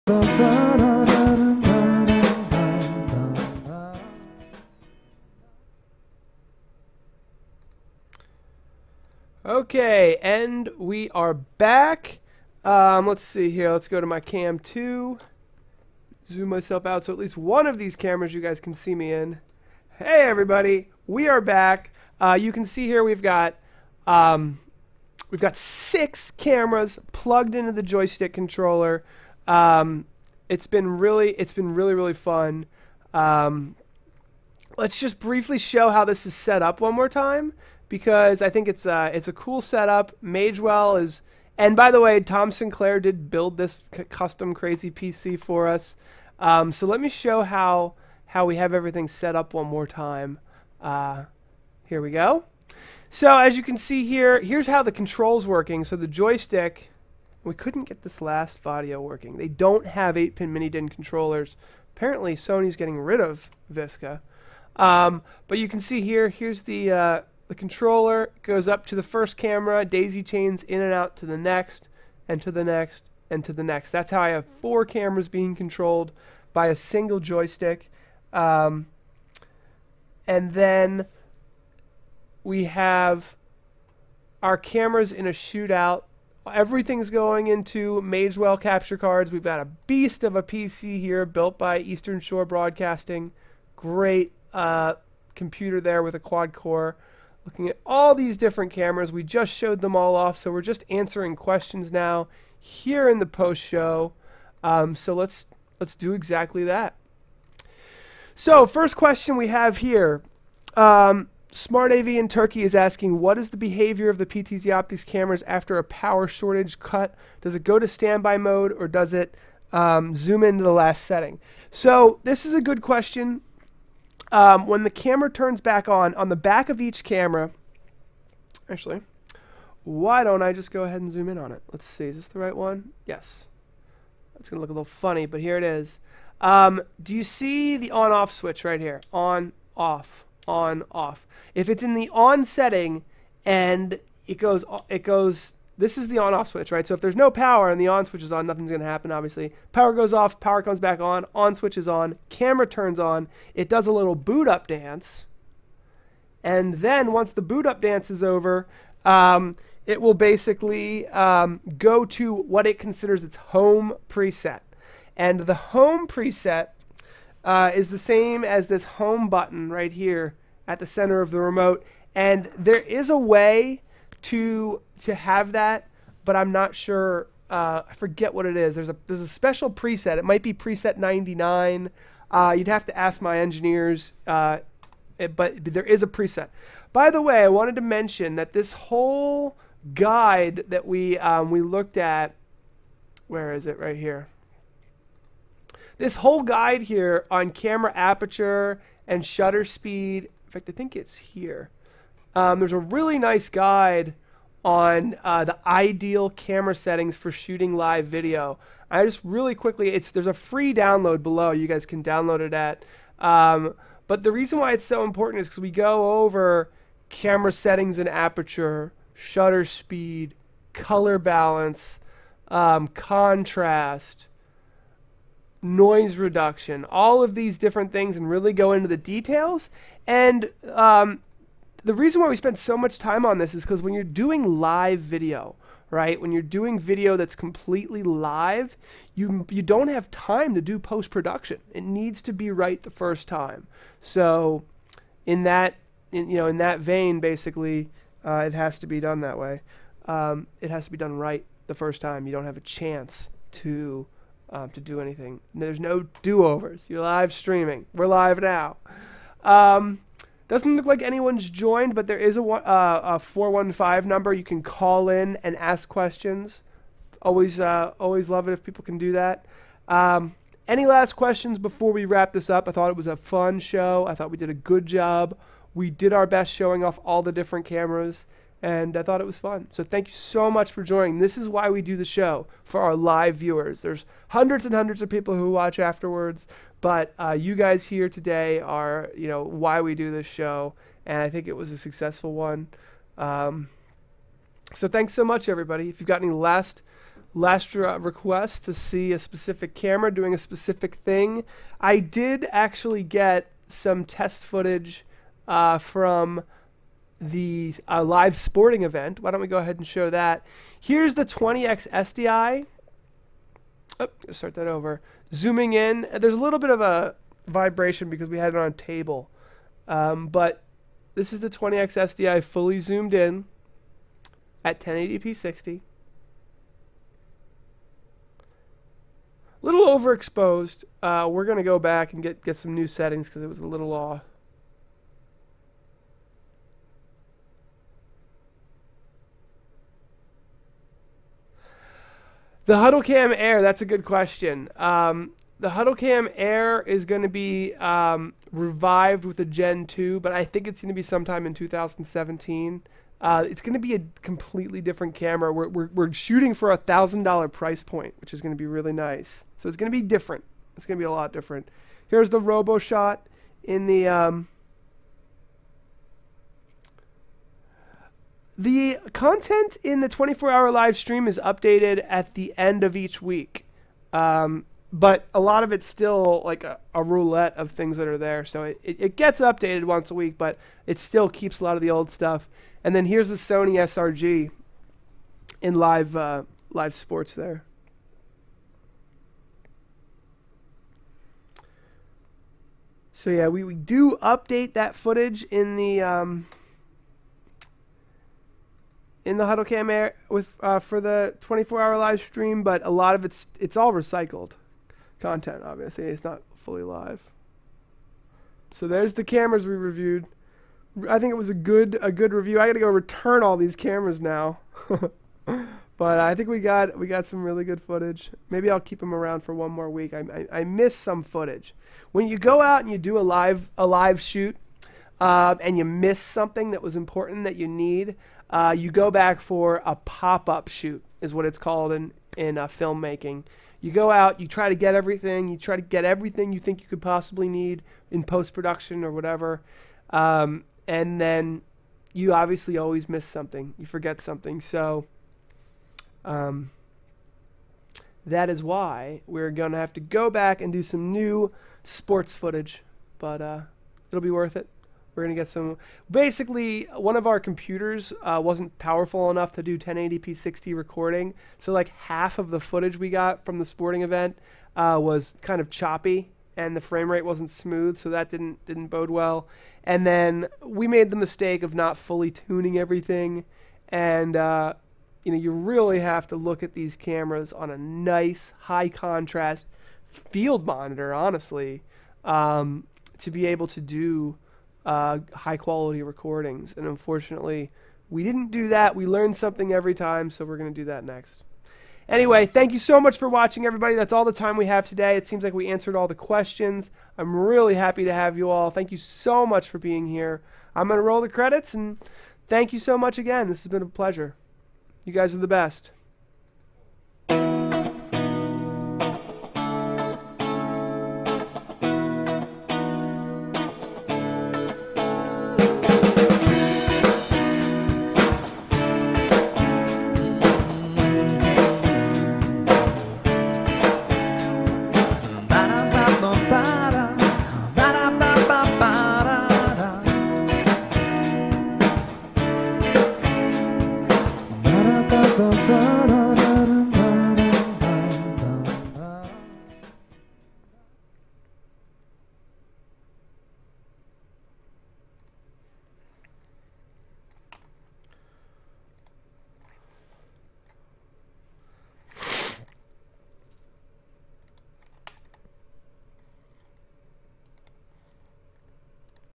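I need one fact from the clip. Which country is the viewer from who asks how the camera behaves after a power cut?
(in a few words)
Turkey.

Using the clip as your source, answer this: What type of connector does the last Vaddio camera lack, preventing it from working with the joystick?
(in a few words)
8-pin mini-DIN.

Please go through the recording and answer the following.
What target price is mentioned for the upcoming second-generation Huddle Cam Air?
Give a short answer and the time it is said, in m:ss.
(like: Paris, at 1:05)
$1,000, at 5:56.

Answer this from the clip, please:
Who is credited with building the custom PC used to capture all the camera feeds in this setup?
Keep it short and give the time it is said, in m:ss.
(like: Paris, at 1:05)
Tom Sinclair, at 0:42.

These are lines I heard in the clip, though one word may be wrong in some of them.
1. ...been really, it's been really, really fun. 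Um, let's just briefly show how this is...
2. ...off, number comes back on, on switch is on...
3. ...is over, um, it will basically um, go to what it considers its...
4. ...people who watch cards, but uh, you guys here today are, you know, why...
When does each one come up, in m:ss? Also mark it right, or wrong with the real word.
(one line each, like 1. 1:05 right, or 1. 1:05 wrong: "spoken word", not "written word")
1. 0:30 right
2. 2:30 wrong: "power", not "number"
3. 2:38 right
4. 4:45 wrong: "afterwards", not "cards".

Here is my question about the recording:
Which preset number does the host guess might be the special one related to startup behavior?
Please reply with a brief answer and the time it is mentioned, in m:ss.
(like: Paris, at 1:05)
99, at 3:00.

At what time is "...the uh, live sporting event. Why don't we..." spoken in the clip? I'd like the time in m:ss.
5:07.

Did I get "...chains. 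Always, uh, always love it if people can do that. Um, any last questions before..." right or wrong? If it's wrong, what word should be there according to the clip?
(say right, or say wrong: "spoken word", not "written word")
wrong: "questions", not "chains".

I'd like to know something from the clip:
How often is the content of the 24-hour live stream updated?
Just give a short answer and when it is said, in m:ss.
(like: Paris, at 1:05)
once a week, at 6:19.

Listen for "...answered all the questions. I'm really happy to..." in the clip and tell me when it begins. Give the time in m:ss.
8:15.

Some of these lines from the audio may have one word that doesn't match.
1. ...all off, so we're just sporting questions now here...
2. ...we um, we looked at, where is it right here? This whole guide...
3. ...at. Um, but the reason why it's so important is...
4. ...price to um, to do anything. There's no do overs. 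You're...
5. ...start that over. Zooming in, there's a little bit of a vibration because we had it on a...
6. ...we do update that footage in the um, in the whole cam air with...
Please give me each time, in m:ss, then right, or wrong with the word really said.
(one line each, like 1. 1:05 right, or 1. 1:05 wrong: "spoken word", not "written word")
1. 1:39 wrong: "answering", not "sporting"
2. 3:10 right
3. 3:32 right
4. 4:12 wrong: "chance", not "price"
5. 5:14 right
6. 6:33 wrong: "huddle", not "whole".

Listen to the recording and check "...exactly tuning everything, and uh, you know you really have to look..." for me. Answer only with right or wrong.
wrong.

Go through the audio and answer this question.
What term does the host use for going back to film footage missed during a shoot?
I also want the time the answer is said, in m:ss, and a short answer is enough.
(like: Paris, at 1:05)
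pop-up shoot, at 7:09.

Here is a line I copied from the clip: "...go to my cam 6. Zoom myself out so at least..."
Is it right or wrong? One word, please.
wrong.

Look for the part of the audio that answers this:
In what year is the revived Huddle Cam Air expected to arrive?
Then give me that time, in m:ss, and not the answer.
5:51.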